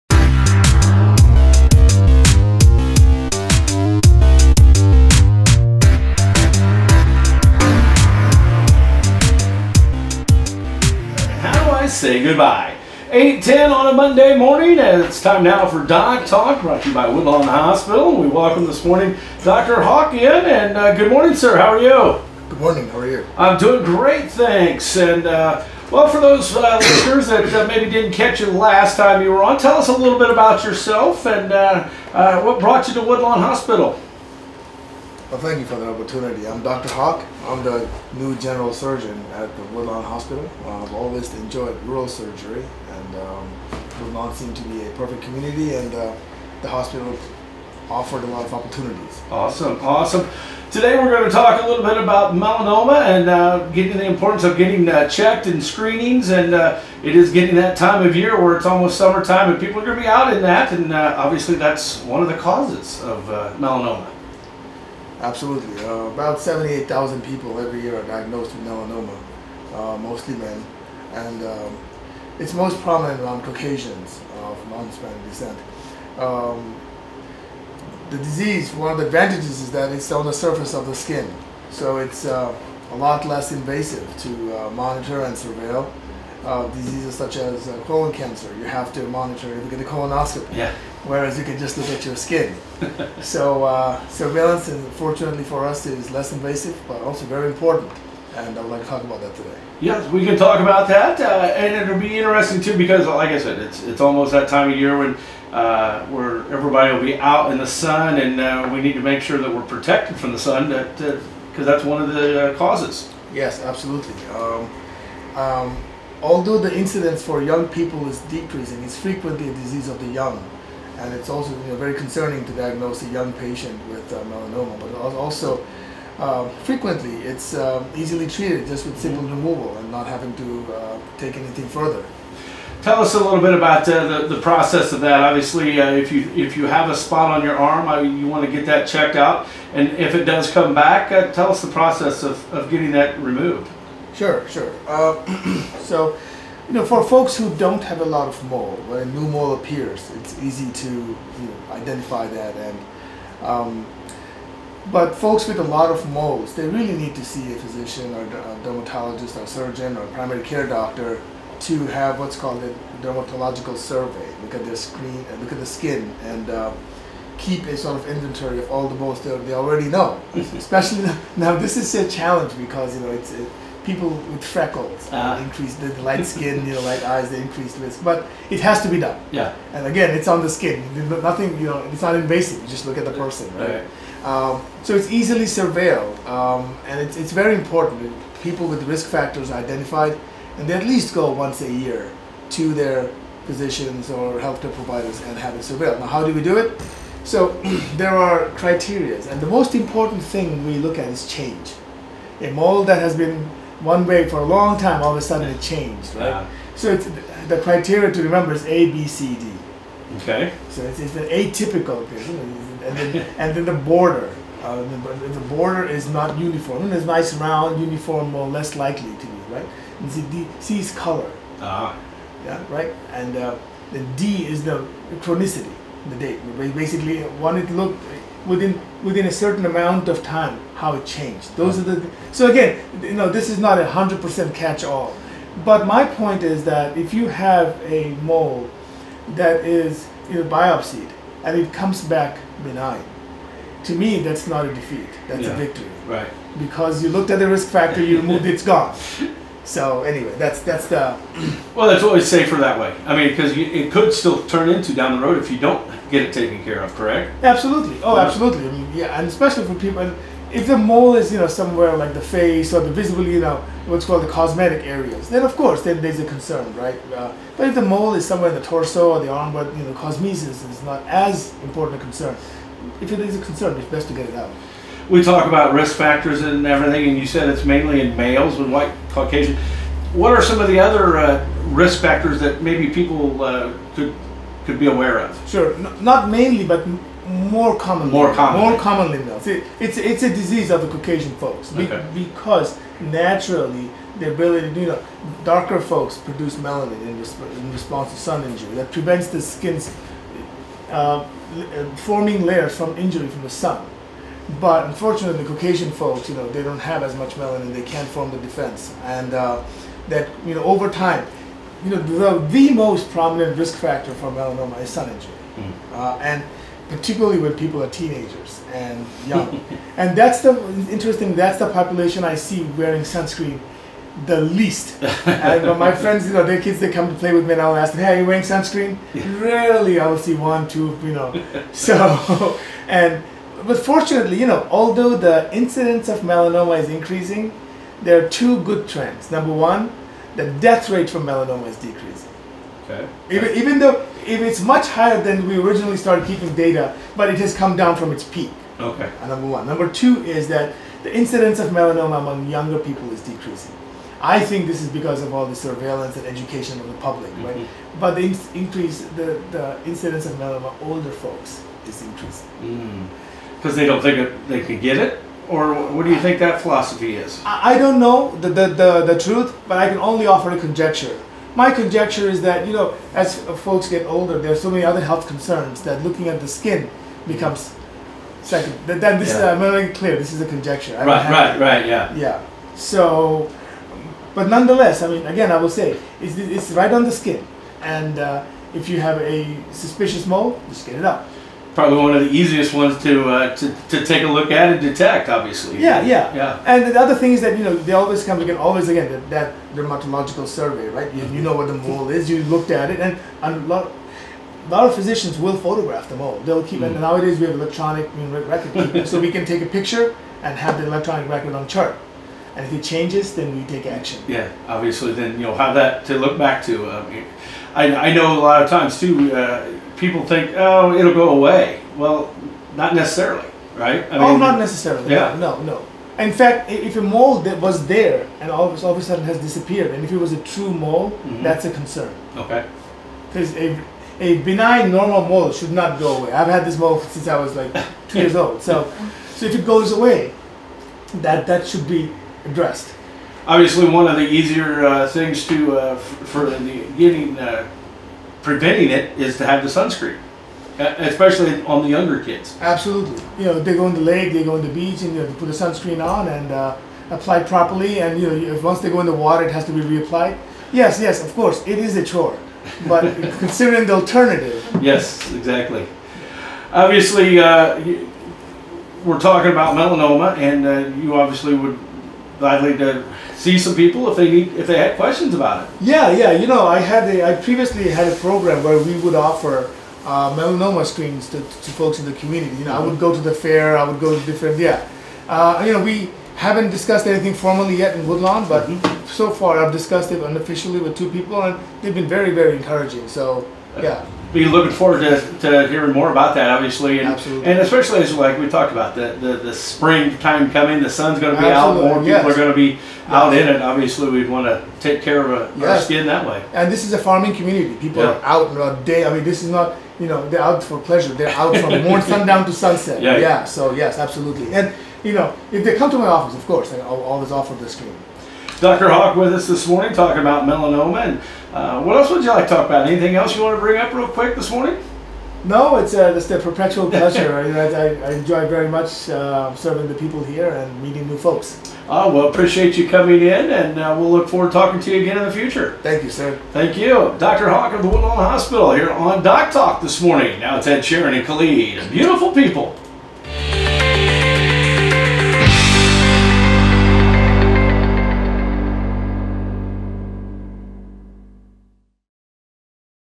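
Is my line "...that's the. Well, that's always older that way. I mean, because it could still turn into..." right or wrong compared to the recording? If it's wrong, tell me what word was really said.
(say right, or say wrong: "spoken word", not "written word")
wrong: "safer", not "older".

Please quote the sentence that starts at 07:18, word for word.
So, so if it goes away, that that should be addressed.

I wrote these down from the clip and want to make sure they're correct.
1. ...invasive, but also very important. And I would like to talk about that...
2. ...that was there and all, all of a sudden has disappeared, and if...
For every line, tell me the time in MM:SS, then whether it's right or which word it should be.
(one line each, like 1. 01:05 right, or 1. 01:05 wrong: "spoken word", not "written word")
1. 01:36 right
2. 07:07 right.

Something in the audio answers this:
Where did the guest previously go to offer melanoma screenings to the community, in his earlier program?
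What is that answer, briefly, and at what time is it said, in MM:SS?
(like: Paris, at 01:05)
the fair, at 08:03.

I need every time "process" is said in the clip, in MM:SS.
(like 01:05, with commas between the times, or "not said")
02:14, 02:21.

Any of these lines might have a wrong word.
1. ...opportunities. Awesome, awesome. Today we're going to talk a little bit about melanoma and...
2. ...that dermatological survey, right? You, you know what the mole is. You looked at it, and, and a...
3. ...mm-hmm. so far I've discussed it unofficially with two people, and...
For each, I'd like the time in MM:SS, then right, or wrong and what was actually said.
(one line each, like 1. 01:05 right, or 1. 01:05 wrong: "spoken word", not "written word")
1. 00:48 right
2. 06:39 right
3. 08:08 right.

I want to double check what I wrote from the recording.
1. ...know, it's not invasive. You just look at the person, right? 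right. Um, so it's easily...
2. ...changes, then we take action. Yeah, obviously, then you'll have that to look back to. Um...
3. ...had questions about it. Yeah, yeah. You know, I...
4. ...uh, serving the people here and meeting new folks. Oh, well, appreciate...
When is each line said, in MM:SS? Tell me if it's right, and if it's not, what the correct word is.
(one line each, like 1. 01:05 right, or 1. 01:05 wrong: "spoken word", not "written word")
1. 03:01 right
2. 06:52 right
3. 07:54 right
4. 08:49 right.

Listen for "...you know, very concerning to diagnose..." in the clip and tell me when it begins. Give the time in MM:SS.
02:01.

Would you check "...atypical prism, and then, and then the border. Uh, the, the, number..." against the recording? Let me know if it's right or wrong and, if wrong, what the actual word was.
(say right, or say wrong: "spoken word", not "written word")
wrong: "border", not "number".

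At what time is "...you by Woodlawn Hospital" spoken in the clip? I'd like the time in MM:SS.
00:16.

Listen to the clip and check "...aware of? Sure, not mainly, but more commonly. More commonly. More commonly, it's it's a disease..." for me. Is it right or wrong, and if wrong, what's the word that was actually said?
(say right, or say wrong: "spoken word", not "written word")
right.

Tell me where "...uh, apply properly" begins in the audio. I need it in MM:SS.
07:36.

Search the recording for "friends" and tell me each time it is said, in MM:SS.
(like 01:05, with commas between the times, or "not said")
05:25.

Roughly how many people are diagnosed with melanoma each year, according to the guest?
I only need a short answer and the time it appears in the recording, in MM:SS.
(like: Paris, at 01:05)
78,000, at 01:06.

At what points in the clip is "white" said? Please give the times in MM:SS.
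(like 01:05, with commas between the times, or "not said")
04:38.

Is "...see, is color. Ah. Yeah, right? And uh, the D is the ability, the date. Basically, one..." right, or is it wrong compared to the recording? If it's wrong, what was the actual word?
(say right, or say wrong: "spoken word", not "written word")
wrong: "chronicity", not "ability".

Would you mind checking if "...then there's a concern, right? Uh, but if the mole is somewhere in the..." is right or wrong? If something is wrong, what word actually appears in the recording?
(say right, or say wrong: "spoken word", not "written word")
right.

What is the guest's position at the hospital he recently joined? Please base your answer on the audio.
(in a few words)
general surgeon.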